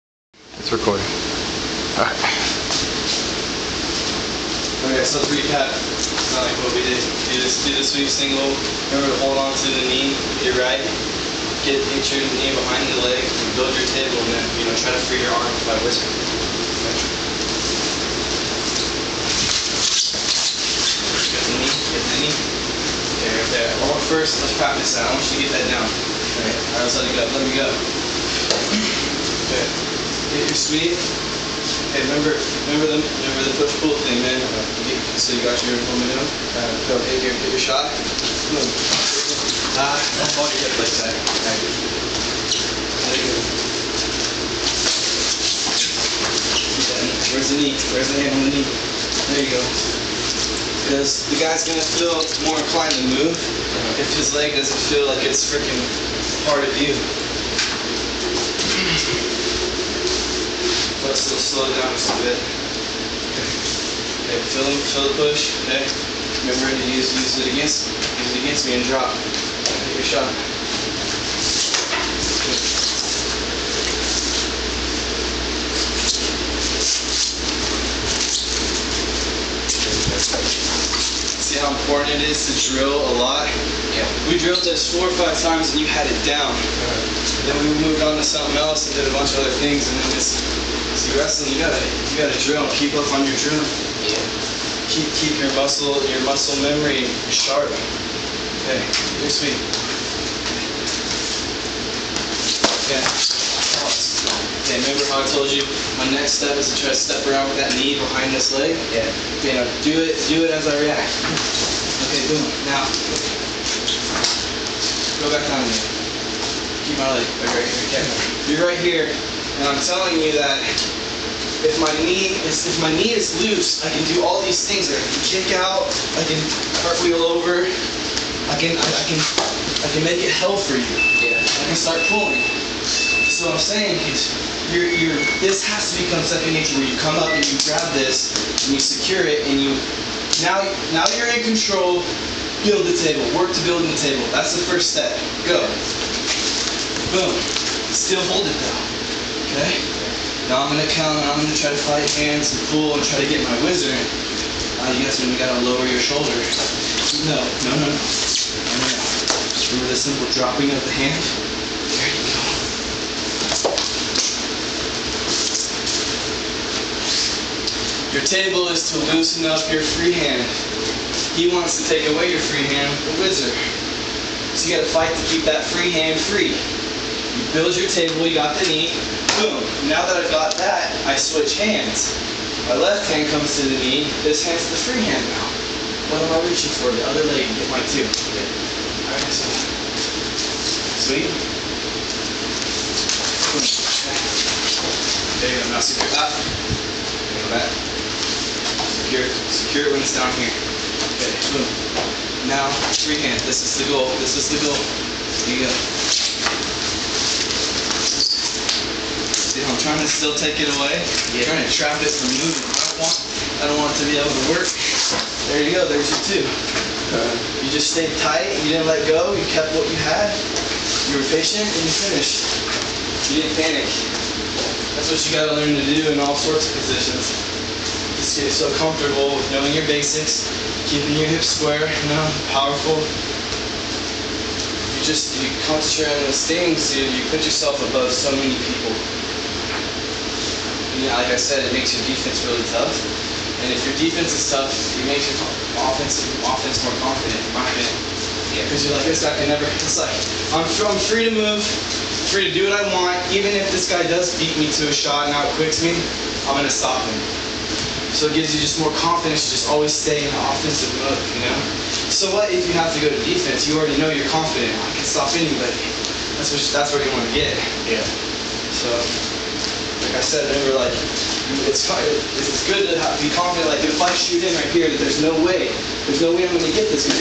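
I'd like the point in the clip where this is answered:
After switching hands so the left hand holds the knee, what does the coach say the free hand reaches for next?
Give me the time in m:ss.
3:06.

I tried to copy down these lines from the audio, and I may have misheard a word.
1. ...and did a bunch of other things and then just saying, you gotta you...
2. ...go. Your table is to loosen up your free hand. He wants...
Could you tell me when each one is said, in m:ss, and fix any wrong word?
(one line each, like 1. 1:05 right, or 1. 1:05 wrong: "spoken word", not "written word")
1. 1:28 wrong: "wrestling", not "saying"
2. 2:42 right.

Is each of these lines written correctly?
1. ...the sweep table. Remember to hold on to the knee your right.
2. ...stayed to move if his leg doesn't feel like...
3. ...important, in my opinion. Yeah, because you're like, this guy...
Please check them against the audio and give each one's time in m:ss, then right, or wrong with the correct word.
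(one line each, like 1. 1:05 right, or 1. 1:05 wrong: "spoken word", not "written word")
1. 0:07 wrong: "single", not "table"
2. 0:52 wrong: "inclined", not "stayed"
3. 4:07 wrong: "confident", not "important".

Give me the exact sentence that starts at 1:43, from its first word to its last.
Okay, remember how I told you my next step is to try to step around with that knee behind this leg?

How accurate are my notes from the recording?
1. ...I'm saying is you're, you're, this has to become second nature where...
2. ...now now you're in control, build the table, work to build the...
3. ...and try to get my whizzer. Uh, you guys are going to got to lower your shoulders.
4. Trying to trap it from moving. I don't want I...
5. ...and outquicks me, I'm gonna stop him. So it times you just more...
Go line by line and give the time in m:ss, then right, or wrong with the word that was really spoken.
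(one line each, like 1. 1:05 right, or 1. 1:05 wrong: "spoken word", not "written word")
1. 2:13 right
2. 2:20 right
3. 2:32 right
4. 3:31 right
5. 4:15 wrong: "gives", not "times".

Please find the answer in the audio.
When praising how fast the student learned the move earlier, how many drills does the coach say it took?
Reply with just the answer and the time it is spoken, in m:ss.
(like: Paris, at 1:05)
4 or 5, at 1:24.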